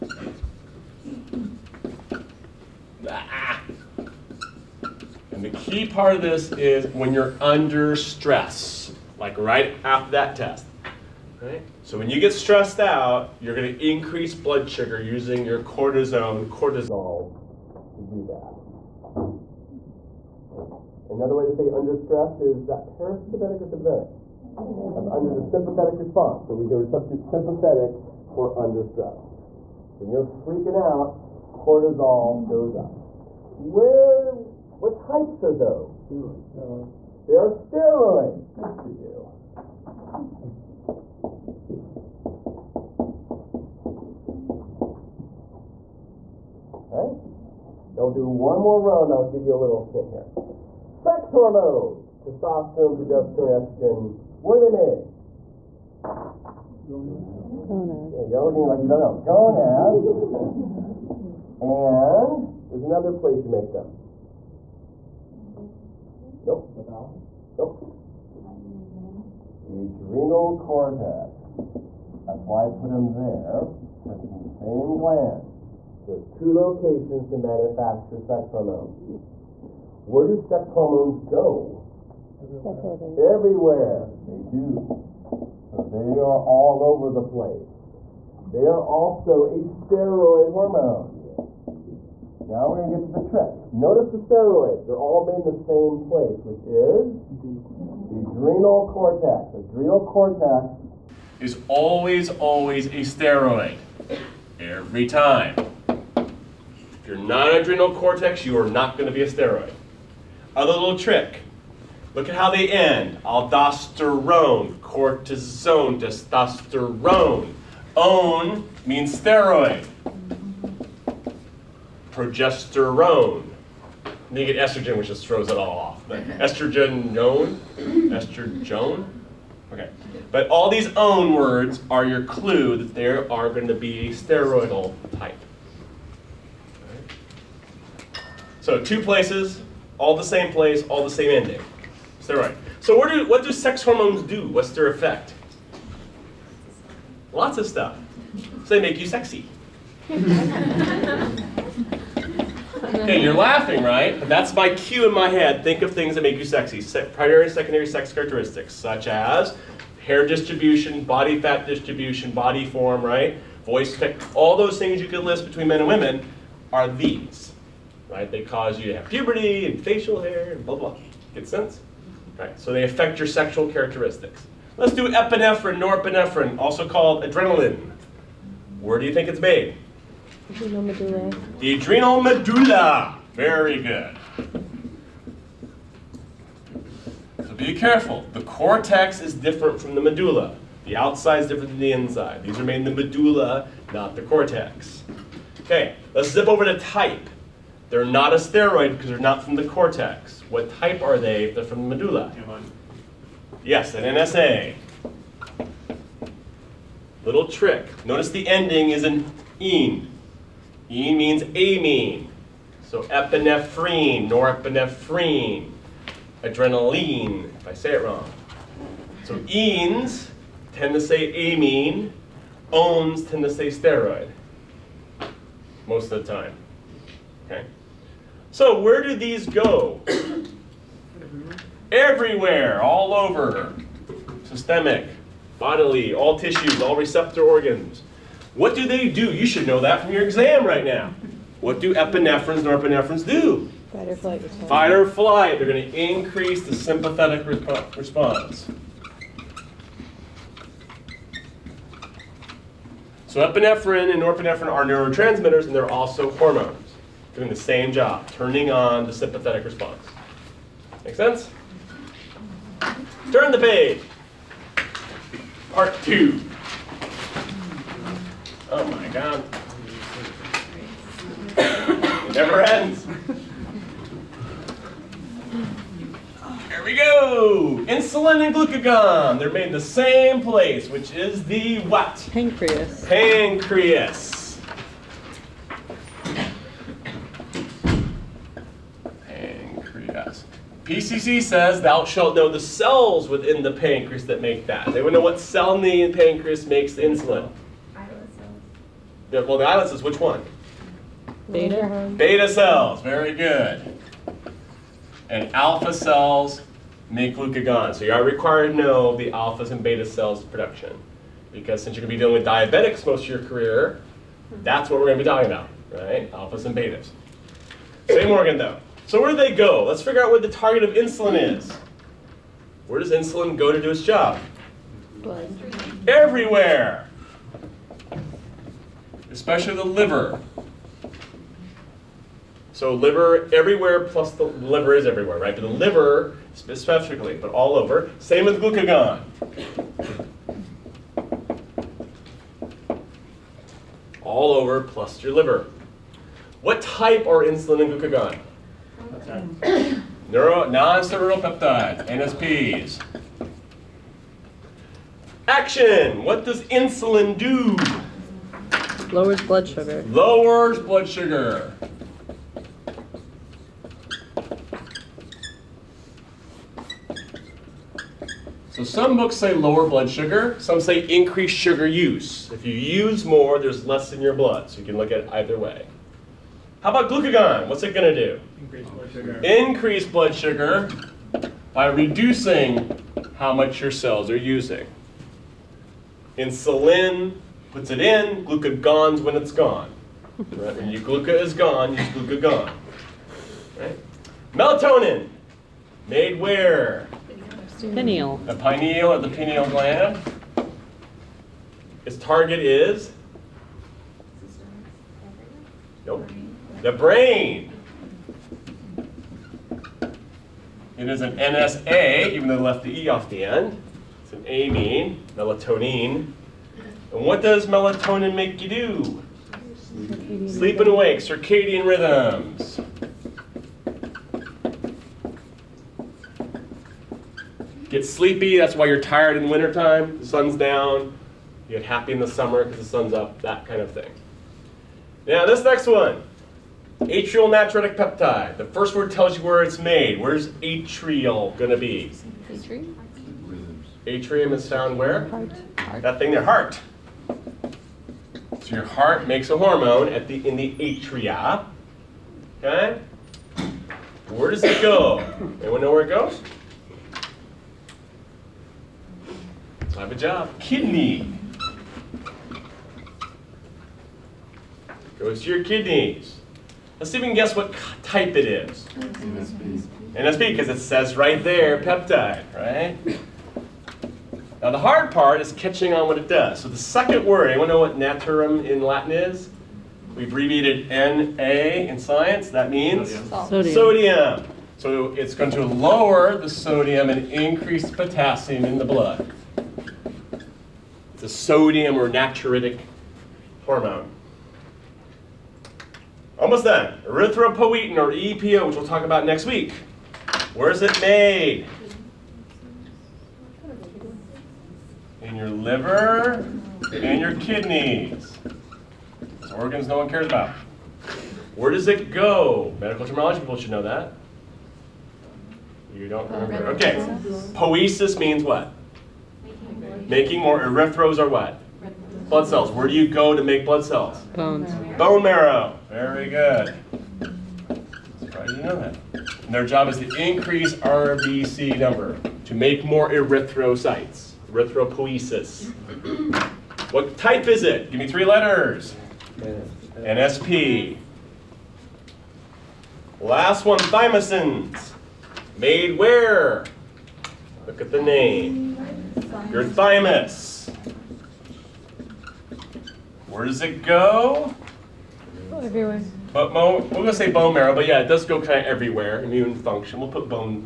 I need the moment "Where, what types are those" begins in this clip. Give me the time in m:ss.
0:33.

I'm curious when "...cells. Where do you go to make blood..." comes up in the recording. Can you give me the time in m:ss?
8:42.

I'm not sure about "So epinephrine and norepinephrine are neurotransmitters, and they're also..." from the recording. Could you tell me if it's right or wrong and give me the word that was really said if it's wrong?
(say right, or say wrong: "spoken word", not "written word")
right.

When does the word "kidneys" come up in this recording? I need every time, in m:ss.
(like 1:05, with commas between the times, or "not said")
7:40, 7:45, 8:27.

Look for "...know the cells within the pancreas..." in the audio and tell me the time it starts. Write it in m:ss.
4:52.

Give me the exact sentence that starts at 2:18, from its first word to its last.
So two places, all the same place, all the same ending.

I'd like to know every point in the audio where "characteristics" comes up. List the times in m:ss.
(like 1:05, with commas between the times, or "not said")
2:38, 2:53.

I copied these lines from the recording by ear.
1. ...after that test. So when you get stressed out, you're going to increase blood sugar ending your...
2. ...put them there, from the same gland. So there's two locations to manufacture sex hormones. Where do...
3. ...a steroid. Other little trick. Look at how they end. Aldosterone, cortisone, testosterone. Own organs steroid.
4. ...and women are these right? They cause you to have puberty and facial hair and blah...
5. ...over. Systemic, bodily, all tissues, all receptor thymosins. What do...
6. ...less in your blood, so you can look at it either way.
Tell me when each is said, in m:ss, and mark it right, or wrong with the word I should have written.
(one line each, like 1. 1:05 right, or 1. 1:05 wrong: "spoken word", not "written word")
1. 0:09 wrong: "using", not "ending"
2. 1:12 right
3. 1:49 wrong: "means", not "organs"
4. 2:45 right
5. 3:53 wrong: "organs", not "thymosins"
6. 6:13 right.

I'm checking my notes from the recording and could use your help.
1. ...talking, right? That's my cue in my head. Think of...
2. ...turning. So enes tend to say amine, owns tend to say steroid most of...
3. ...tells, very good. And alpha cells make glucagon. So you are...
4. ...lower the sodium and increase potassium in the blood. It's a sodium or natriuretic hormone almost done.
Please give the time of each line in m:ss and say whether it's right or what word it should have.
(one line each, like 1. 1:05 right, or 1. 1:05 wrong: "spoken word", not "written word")
1. 2:33 wrong: "laughing", not "talking"
2. 3:38 wrong: "wrong", not "turning"
3. 5:02 wrong: "cells", not "tells"
4. 8:05 right.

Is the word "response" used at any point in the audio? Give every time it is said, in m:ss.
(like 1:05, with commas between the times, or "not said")
0:25, 4:07, 4:19.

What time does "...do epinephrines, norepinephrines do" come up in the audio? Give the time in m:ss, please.
4:01.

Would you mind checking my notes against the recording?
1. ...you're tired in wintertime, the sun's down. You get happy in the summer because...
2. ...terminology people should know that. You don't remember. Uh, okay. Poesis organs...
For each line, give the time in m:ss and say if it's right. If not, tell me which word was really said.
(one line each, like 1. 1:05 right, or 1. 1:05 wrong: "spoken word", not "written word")
1. 7:08 right
2. 8:33 wrong: "means", not "organs".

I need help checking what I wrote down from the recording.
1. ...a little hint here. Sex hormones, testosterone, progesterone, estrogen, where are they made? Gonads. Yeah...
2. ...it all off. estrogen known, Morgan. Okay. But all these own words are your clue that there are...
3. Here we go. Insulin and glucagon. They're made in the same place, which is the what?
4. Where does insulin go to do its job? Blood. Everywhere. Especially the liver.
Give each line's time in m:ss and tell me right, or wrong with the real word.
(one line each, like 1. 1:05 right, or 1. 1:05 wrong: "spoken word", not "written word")
1. 0:49 right
2. 2:05 wrong: "Estrogen", not "Morgan"
3. 4:36 right
4. 5:22 right.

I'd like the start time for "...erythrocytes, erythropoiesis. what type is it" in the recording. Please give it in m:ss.
8:53.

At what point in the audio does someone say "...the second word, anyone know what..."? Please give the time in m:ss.
7:56.